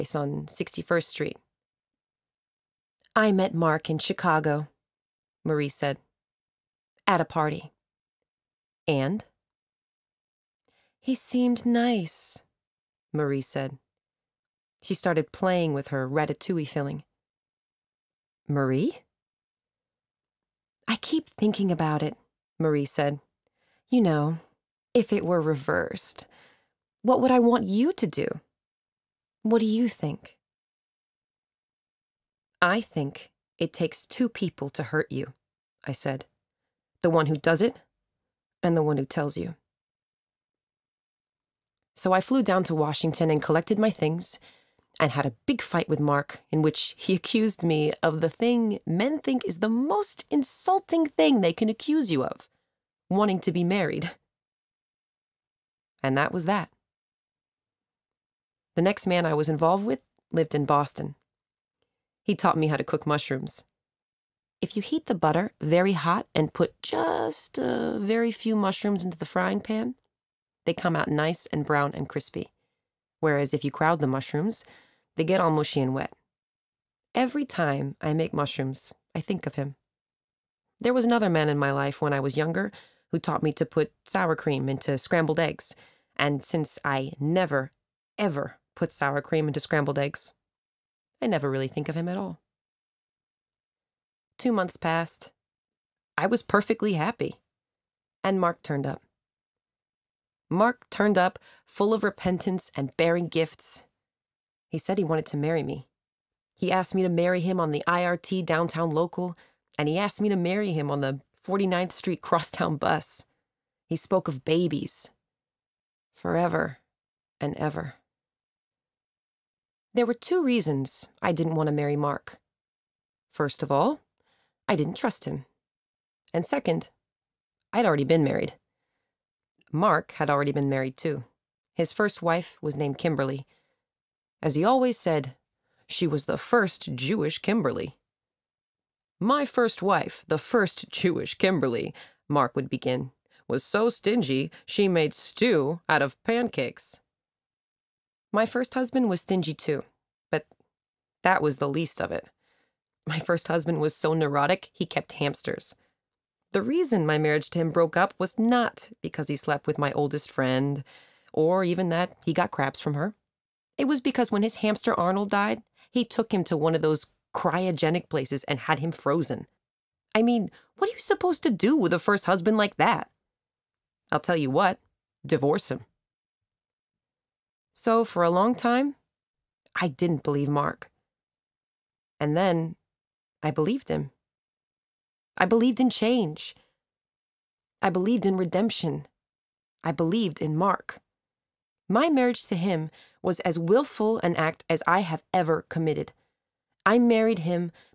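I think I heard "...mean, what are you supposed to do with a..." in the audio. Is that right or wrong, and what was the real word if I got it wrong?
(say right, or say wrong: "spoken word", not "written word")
right.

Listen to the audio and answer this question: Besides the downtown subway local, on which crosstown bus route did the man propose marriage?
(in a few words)
49th Street crosstown bus.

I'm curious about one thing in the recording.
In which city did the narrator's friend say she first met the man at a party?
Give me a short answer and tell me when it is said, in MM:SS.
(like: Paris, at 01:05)
Chicago, at 00:03.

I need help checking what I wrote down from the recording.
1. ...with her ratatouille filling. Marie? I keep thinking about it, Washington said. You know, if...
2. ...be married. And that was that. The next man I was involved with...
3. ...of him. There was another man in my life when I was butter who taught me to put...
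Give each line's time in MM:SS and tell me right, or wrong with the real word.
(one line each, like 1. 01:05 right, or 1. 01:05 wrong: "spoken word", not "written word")
1. 00:15 wrong: "Marie", not "Washington"
2. 00:53 right
3. 01:19 wrong: "younger", not "butter".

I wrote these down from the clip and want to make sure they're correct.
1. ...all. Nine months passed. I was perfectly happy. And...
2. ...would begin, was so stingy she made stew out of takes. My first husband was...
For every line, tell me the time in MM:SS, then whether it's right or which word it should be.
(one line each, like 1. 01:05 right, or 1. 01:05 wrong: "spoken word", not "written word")
1. 01:32 wrong: "Two", not "Nine"
2. 02:22 wrong: "pancakes", not "takes".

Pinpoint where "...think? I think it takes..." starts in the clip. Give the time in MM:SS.
00:29.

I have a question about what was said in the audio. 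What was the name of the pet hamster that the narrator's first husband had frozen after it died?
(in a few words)
Arnold.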